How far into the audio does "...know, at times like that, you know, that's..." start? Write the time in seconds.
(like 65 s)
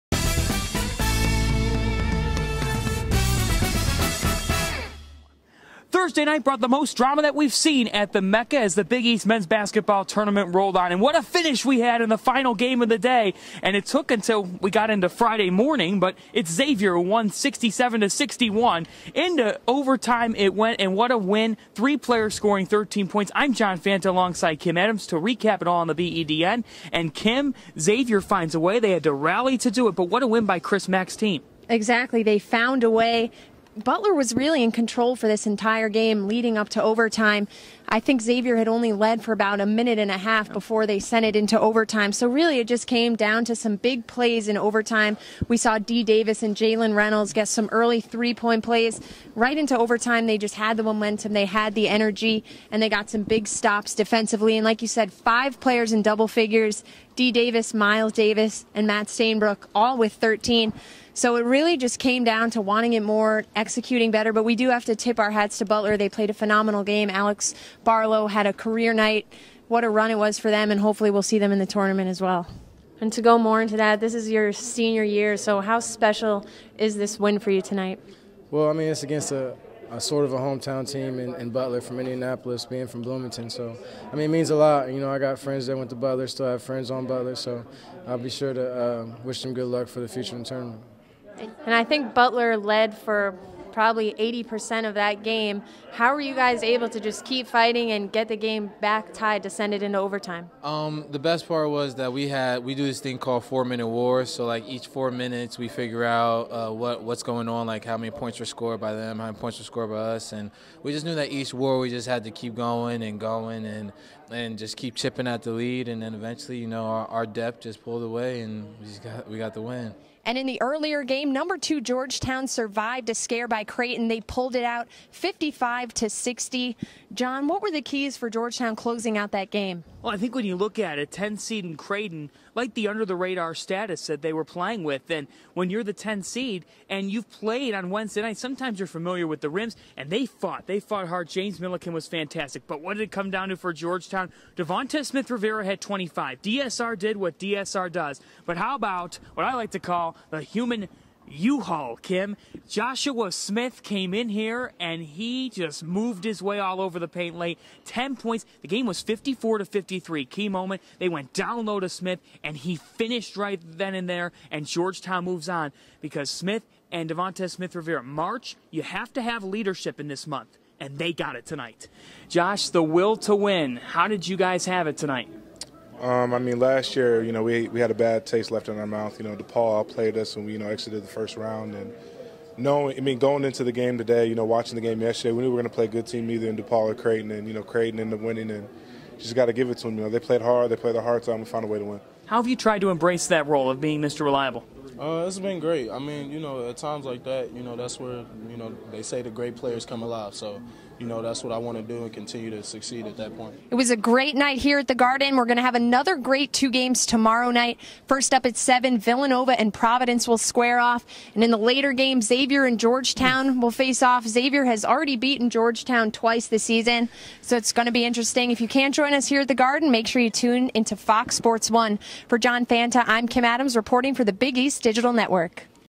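196 s.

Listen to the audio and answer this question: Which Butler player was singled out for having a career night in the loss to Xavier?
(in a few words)
Alex Barlow.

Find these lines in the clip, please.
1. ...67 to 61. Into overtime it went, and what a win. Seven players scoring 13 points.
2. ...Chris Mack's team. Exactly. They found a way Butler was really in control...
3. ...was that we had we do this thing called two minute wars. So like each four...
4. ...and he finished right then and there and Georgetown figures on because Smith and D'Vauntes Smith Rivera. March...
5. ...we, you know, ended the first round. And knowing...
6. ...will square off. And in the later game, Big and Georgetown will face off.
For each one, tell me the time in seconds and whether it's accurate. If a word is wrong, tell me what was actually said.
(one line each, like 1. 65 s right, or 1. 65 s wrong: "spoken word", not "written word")
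1. 17 s wrong: "Three", not "Seven"
2. 30 s right
3. 101 s wrong: "four", not "two"
4. 162 s wrong: "moves", not "figures"
5. 180 s wrong: "exited", not "ended"
6. 210 s wrong: "Xavier", not "Big".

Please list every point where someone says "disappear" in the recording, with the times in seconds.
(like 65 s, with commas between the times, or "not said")
not said.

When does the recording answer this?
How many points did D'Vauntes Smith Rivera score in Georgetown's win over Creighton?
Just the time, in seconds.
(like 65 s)
145 s.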